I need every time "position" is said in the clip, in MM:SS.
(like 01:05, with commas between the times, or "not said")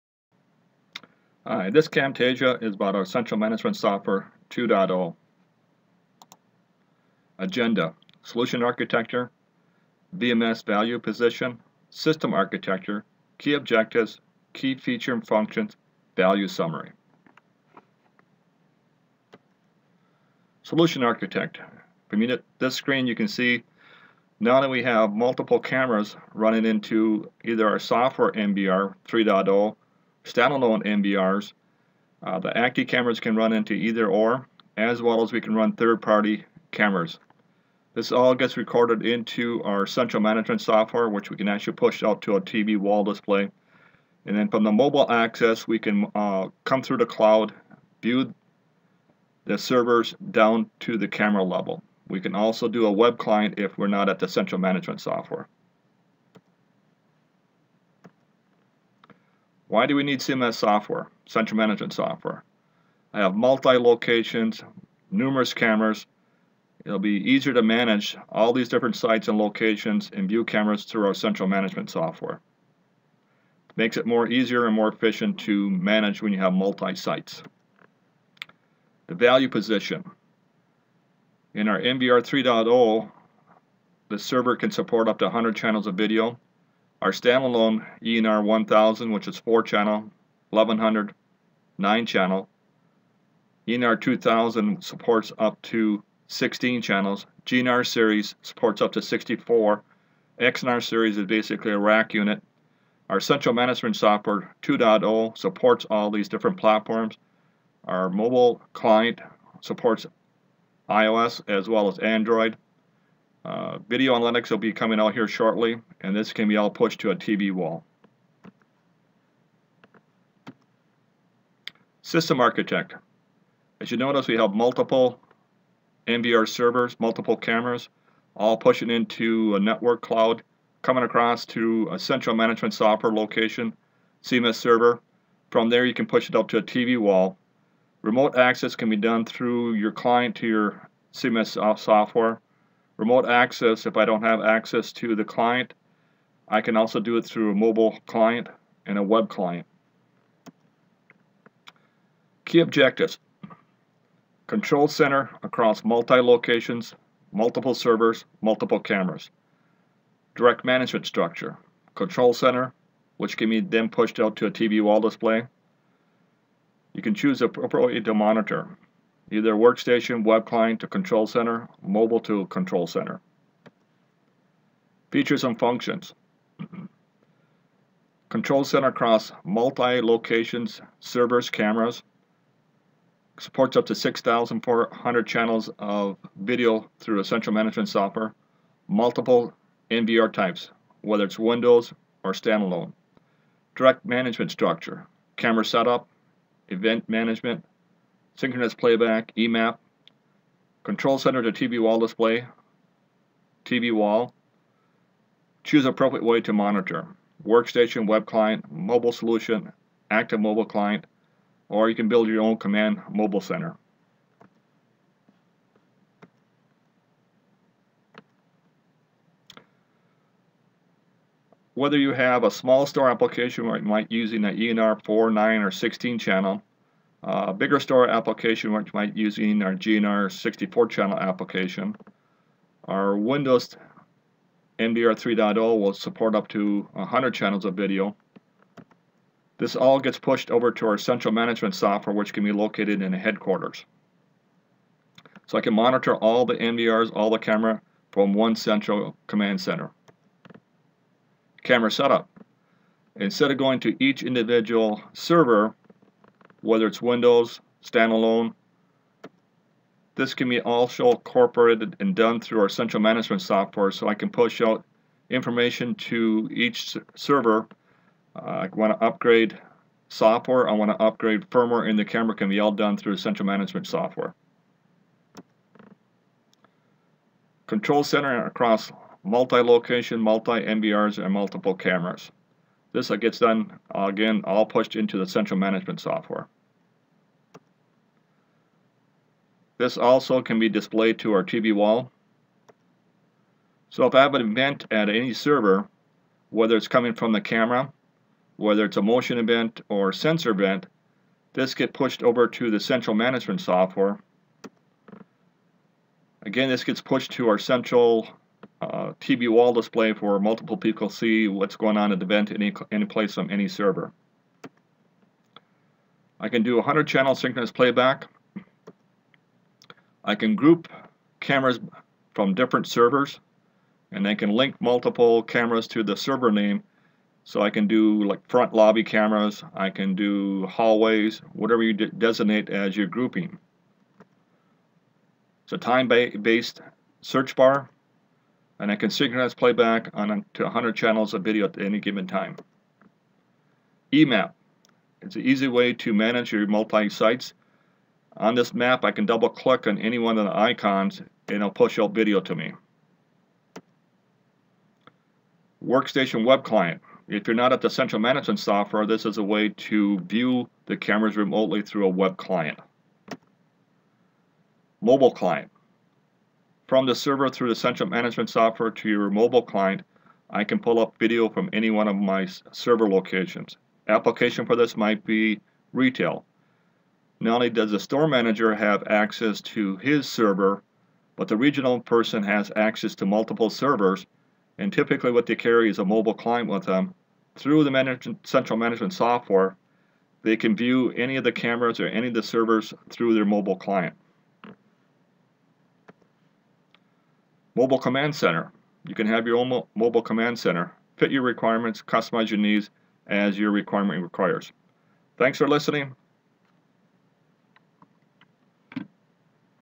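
00:10, 01:19.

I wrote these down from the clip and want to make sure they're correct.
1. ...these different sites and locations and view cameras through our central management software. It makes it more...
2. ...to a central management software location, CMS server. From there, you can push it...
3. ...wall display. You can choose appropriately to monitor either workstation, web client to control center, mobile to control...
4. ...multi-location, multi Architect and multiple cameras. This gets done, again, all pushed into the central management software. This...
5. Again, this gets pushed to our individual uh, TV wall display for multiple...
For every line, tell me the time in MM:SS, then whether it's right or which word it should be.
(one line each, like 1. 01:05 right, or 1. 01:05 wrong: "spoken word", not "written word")
1. 01:08 right
2. 02:11 right
3. 02:44 right
4. 04:39 wrong: "NVRs", not "Architect"
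5. 05:06 wrong: "central", not "individual".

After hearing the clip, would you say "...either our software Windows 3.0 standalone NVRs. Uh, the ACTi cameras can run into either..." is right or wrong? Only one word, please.
wrong.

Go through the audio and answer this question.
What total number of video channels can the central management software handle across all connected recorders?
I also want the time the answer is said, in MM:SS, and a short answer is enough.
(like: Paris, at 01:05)
6,400, at 03:03.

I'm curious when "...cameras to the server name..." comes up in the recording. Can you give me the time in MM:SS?
05:25.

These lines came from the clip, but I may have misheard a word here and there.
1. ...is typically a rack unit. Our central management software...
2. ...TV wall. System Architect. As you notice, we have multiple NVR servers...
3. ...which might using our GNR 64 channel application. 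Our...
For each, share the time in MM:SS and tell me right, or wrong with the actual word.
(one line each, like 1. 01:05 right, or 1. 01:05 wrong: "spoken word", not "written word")
1. 01:41 wrong: "basically", not "typically"
2. 01:57 right
3. 03:48 right.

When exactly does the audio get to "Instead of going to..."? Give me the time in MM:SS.
04:13.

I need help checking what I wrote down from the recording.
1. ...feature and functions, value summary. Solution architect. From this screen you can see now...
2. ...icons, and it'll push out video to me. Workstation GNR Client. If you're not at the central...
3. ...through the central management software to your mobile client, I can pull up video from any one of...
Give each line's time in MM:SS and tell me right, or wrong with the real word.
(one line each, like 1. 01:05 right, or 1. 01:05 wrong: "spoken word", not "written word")
1. 00:14 right
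2. 05:50 wrong: "Web", not "GNR"
3. 06:07 right.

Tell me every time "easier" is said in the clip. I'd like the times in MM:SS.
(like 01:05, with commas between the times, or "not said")
01:07, 01:14.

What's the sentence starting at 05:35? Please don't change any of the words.
It's a time-based search bar and I can synchronize playback on to 100 channels of video at any given time.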